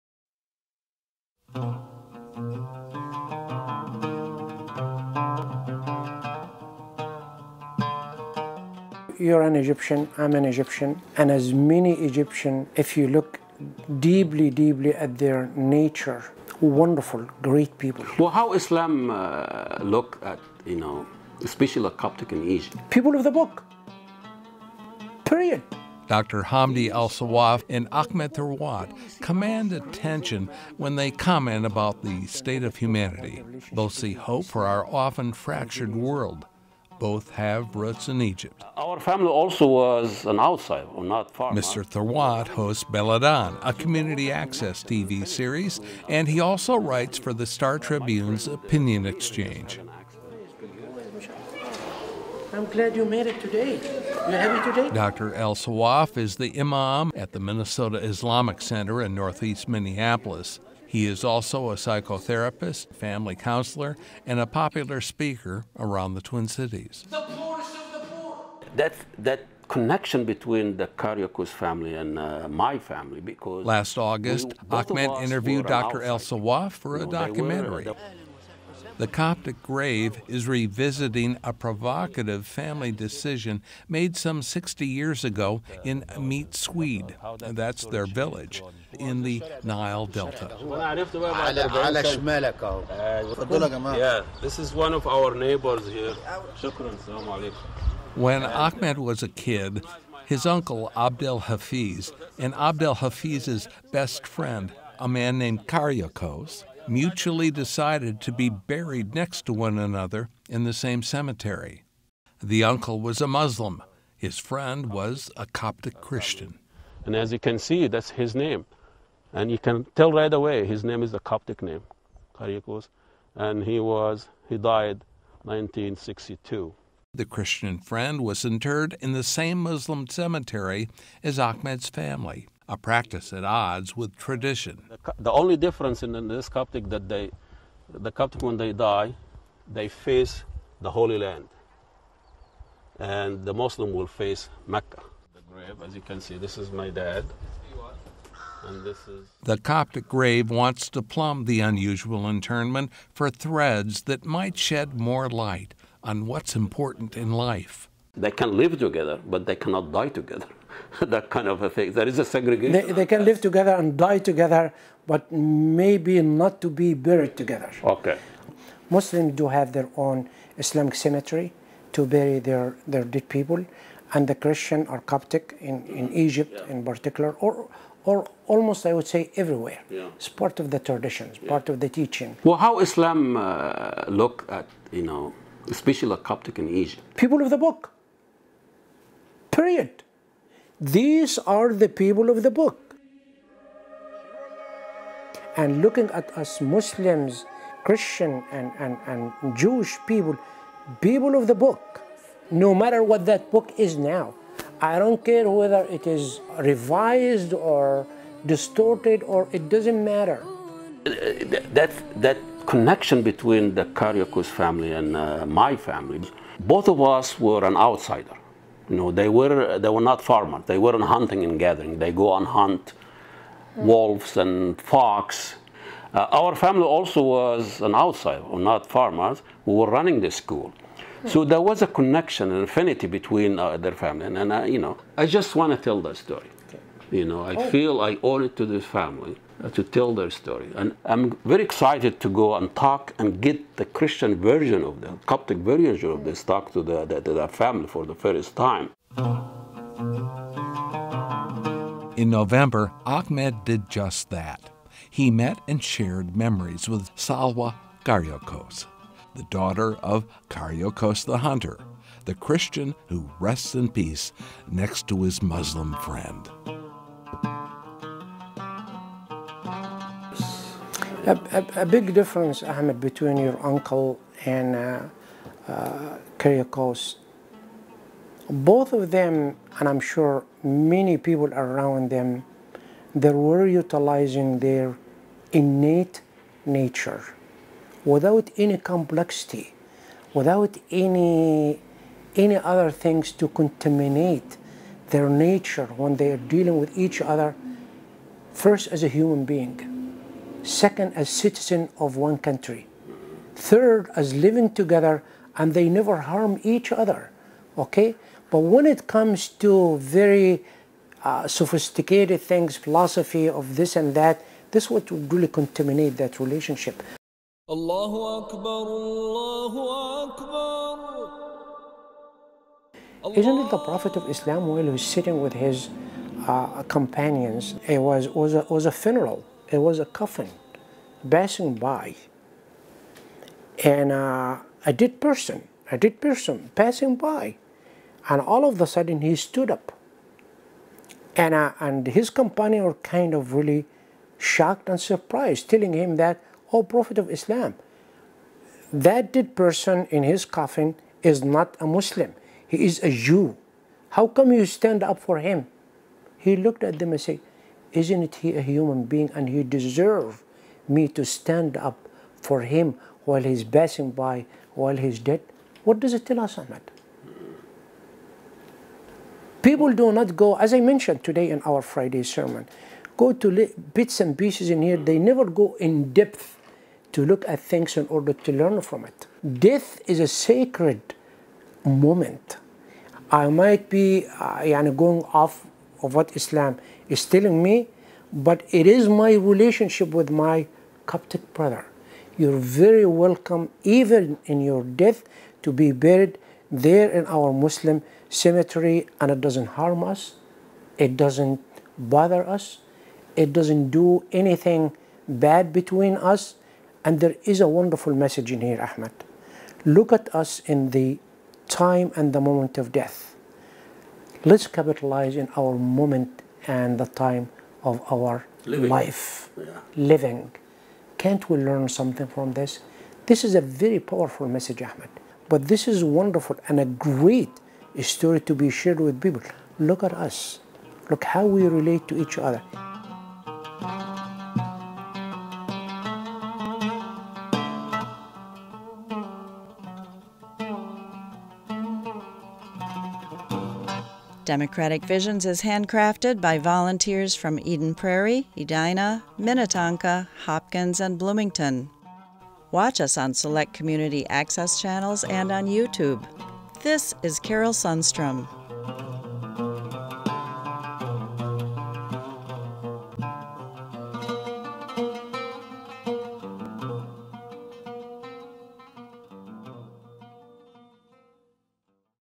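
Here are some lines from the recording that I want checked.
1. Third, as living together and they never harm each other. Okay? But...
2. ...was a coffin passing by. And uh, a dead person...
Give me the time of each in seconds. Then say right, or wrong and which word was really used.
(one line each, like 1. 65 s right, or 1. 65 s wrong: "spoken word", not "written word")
1. 303 s right
2. 329 s right.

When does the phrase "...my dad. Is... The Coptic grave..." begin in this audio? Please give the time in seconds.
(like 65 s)
146 s.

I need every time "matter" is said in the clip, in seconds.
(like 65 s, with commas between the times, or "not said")
202 s, 210 s.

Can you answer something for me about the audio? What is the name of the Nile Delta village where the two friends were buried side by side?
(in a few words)
Meet Swede.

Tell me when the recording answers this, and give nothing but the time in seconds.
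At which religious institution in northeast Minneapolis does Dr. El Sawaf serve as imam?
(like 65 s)
57 s.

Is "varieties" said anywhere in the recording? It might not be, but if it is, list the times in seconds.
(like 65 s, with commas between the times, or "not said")
not said.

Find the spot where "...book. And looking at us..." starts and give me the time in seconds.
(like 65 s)
192 s.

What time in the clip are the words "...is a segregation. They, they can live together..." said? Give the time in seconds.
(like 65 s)
162 s.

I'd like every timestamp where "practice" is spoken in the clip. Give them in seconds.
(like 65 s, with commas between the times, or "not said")
132 s.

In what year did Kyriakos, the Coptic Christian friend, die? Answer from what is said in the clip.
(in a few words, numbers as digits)
1962.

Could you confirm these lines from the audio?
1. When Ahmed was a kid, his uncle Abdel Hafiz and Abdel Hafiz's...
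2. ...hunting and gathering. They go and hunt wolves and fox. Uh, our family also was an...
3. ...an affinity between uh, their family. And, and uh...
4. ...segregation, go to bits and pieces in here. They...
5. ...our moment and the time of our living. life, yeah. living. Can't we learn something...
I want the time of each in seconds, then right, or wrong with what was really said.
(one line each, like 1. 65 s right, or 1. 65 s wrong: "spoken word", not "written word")
1. 98 s right
2. 221 s right
3. 232 s right
4. 372 s wrong: "sermon", not "segregation"
5. 415 s right.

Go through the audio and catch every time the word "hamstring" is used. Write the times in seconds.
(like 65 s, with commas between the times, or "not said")
not said.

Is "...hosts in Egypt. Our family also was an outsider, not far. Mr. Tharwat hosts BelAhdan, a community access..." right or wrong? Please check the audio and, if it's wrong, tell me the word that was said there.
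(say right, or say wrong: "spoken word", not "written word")
wrong: "roots", not "hosts".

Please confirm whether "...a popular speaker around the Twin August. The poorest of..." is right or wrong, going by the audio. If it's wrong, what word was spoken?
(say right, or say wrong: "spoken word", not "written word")
wrong: "Cities", not "August".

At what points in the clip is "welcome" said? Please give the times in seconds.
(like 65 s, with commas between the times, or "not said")
393 s.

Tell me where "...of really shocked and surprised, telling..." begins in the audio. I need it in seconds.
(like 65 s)
343 s.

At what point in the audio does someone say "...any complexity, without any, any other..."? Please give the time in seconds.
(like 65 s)
288 s.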